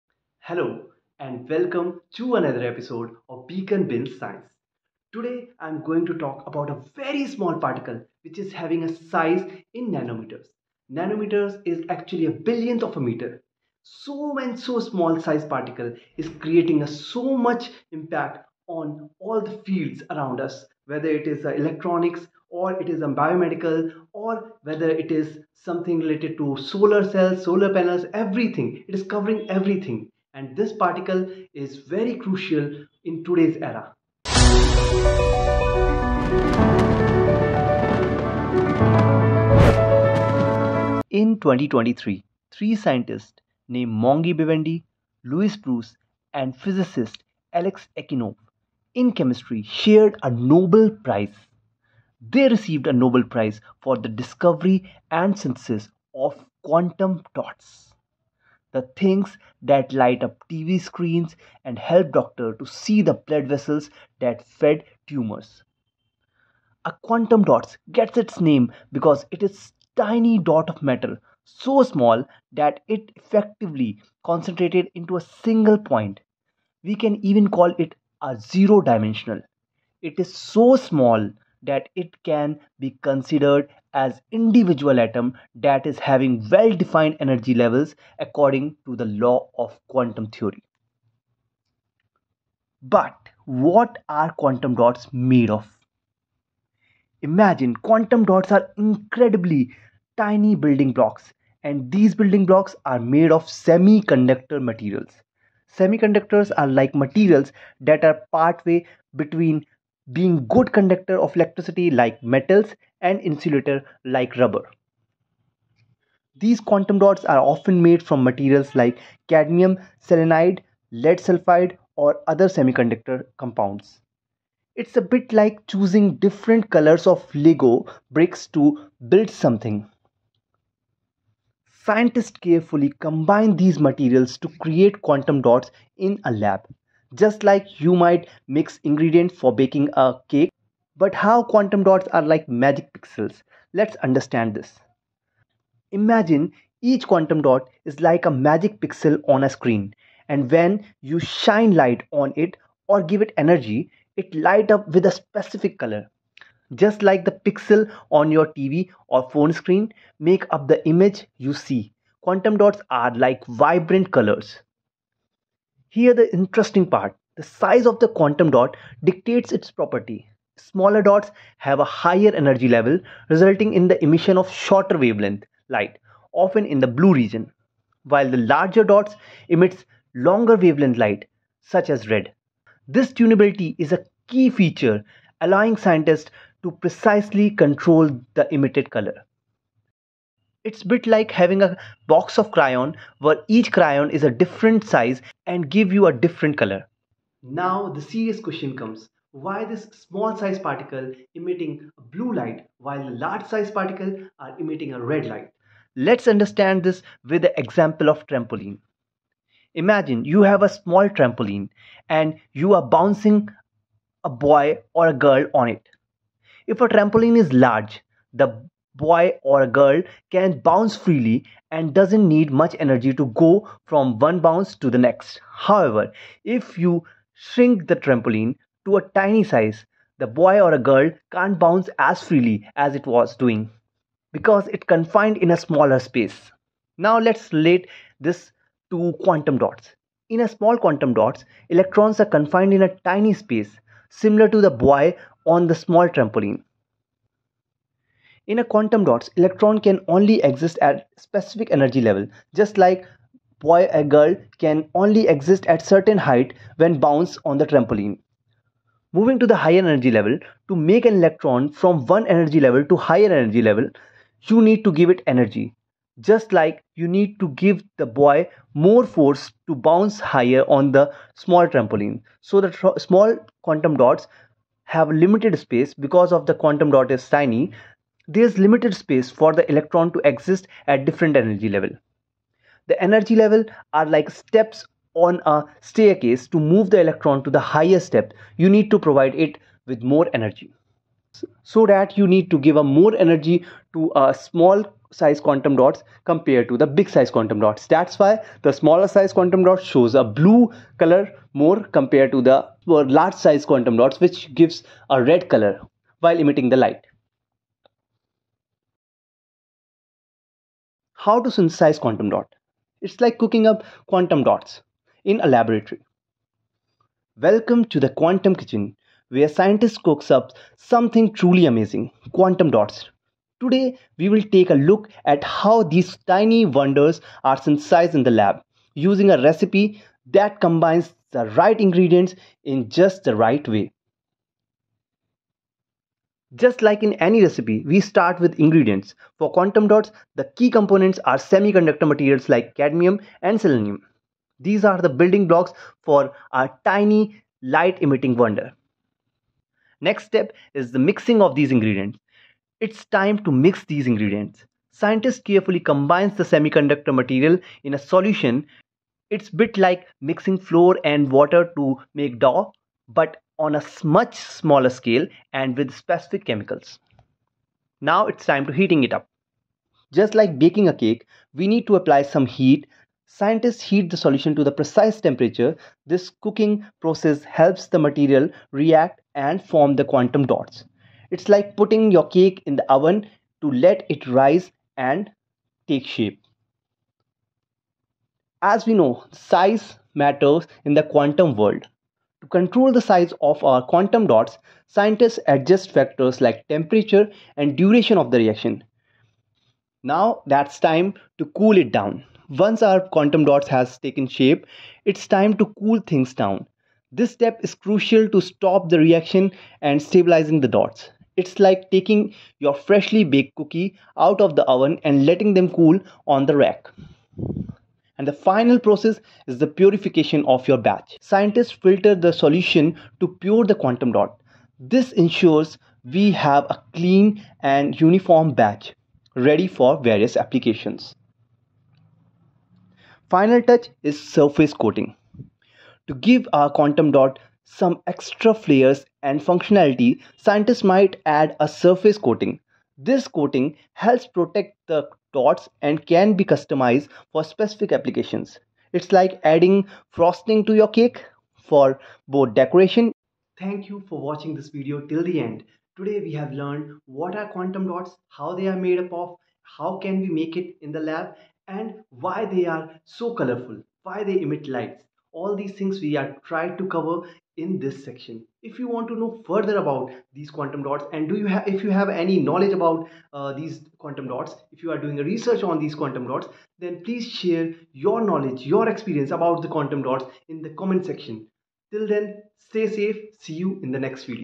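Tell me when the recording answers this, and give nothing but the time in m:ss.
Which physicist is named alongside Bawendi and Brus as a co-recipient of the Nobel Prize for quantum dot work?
0:47.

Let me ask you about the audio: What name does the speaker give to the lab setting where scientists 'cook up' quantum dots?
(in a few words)
Quantum Kitchen.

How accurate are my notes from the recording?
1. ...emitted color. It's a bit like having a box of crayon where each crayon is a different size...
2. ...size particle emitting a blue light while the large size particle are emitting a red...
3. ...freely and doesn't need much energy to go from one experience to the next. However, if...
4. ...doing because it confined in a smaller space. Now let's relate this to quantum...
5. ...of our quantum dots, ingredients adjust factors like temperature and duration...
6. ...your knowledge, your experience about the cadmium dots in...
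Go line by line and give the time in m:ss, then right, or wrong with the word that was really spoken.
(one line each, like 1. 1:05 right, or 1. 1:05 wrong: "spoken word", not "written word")
1. 3:08 right
2. 3:20 right
3. 3:40 wrong: "bounce", not "experience"
4. 3:53 right
5. 6:33 wrong: "scientists", not "ingredients"
6. 7:57 wrong: "quantum", not "cadmium".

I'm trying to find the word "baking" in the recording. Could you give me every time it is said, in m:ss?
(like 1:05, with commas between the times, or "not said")
2:19, 6:10.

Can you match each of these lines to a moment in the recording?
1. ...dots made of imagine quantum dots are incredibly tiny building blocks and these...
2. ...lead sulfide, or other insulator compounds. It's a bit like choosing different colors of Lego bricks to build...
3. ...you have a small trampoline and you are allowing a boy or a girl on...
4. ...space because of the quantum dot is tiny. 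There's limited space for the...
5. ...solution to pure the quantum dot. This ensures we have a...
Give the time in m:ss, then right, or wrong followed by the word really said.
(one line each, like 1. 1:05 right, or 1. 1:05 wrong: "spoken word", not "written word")
1. 1:34 right
2. 2:00 wrong: "semiconductor", not "insulator"
3. 3:30 wrong: "bouncing", not "allowing"
4. 4:35 right
5. 7:02 right.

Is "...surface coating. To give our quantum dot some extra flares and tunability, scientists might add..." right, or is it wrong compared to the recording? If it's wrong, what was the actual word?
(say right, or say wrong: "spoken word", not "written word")
wrong: "functionality", not "tunability".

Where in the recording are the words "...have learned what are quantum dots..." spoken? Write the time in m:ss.
7:36.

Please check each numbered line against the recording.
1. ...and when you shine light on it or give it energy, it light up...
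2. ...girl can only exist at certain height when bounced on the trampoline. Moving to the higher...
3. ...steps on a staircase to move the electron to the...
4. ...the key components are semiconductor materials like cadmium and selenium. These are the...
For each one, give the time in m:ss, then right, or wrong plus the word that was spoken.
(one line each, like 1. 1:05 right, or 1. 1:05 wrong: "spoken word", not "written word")
1. 2:30 right
2. 4:14 right
3. 4:44 right
4. 5:40 right.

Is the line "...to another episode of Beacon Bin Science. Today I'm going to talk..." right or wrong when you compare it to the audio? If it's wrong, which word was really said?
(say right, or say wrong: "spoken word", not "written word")
right.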